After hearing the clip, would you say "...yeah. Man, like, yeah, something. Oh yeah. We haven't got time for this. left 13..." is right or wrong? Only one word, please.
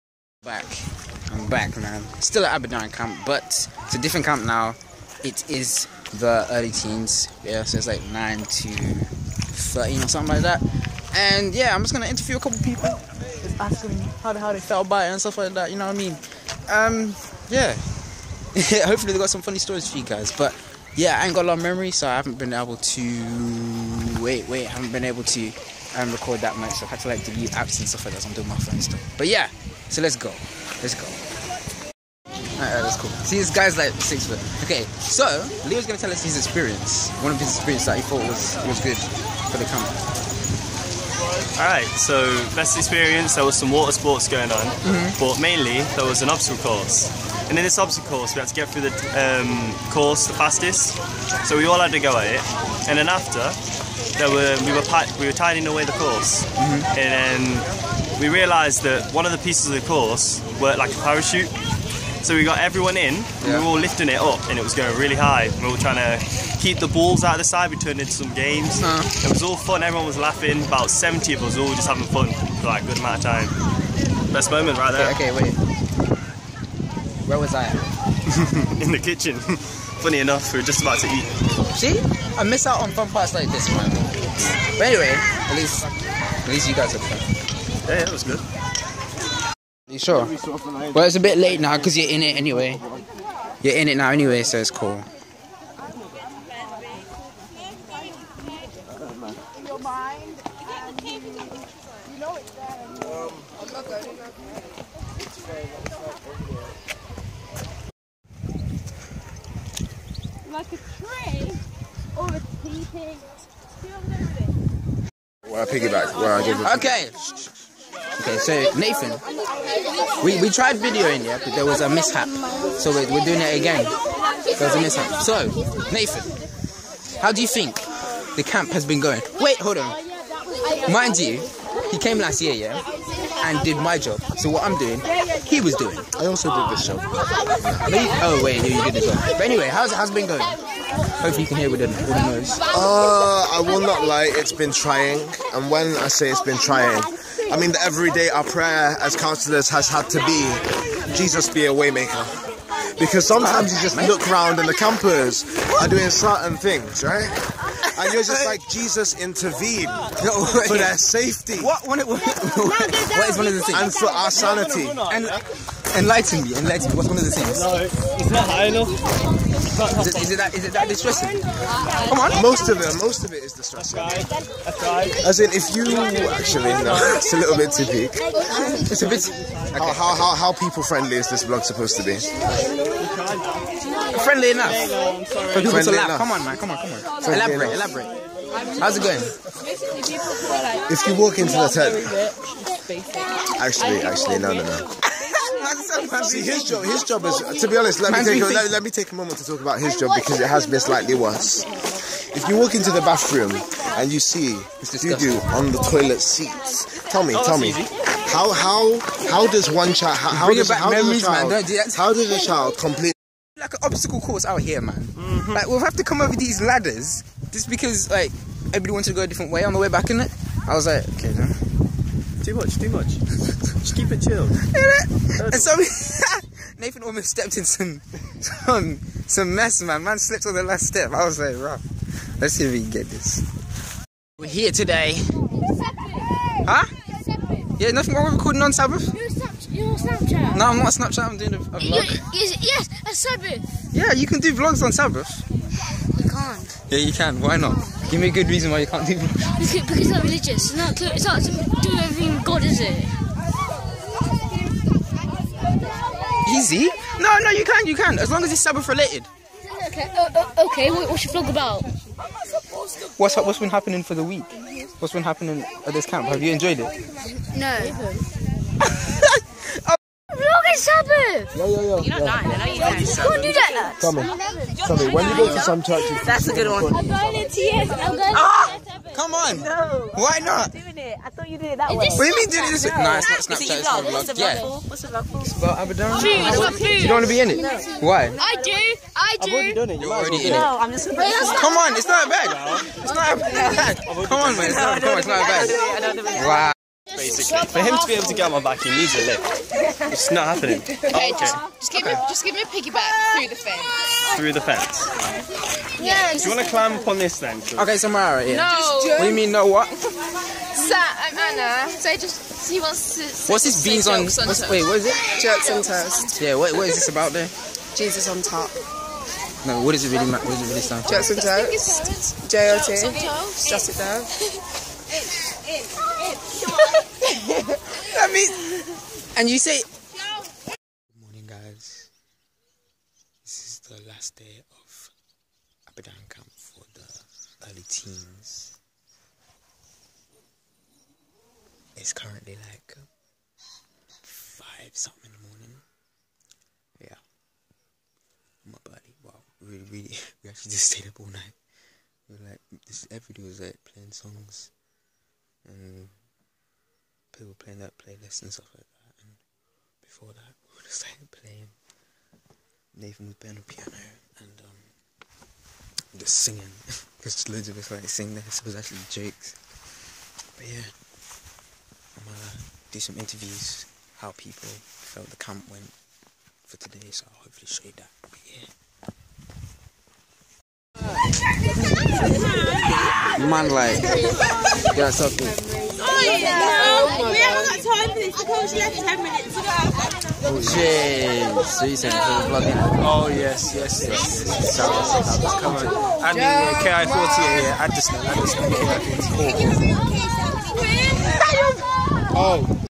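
wrong.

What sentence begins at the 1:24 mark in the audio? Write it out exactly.
But anyway, at least, at least you guys are fun.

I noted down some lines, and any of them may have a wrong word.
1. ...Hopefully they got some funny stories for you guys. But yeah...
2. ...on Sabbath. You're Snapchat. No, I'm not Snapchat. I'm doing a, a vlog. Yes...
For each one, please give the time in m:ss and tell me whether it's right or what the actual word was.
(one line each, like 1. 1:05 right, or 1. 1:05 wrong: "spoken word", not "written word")
1. 0:18 right
2. 3:58 right.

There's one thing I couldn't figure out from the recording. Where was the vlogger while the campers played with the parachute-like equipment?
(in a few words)
In the kitchen.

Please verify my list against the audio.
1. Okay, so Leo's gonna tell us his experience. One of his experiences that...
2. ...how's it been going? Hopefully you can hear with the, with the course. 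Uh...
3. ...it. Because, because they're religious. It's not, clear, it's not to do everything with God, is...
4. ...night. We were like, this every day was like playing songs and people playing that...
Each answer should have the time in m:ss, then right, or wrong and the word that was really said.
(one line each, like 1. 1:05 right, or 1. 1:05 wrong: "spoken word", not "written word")
1. 0:34 right
2. 2:19 wrong: "noise", not "course"
3. 4:09 right
4. 5:51 right.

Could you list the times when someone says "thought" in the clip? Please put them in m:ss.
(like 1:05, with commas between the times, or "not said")
0:38, 4:41.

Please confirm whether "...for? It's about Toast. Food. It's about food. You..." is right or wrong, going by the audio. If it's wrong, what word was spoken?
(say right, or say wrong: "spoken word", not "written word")
wrong: "Aberdaron", not "Toast".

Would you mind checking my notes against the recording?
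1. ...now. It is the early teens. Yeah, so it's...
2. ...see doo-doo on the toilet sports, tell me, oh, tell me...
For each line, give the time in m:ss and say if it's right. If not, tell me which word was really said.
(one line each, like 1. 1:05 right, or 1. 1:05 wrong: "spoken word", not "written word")
1. 0:04 right
2. 3:24 wrong: "seats", not "sports".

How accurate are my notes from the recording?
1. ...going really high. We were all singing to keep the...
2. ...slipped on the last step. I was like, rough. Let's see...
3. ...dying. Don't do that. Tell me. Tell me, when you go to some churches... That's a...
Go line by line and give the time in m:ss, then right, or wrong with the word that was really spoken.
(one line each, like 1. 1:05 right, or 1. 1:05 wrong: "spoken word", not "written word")
1. 1:04 wrong: "trying", not "singing"
2. 3:50 right
3. 4:32 right.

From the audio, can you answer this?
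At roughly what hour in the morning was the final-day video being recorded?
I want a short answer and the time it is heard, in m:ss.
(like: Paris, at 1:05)
5, at 5:44.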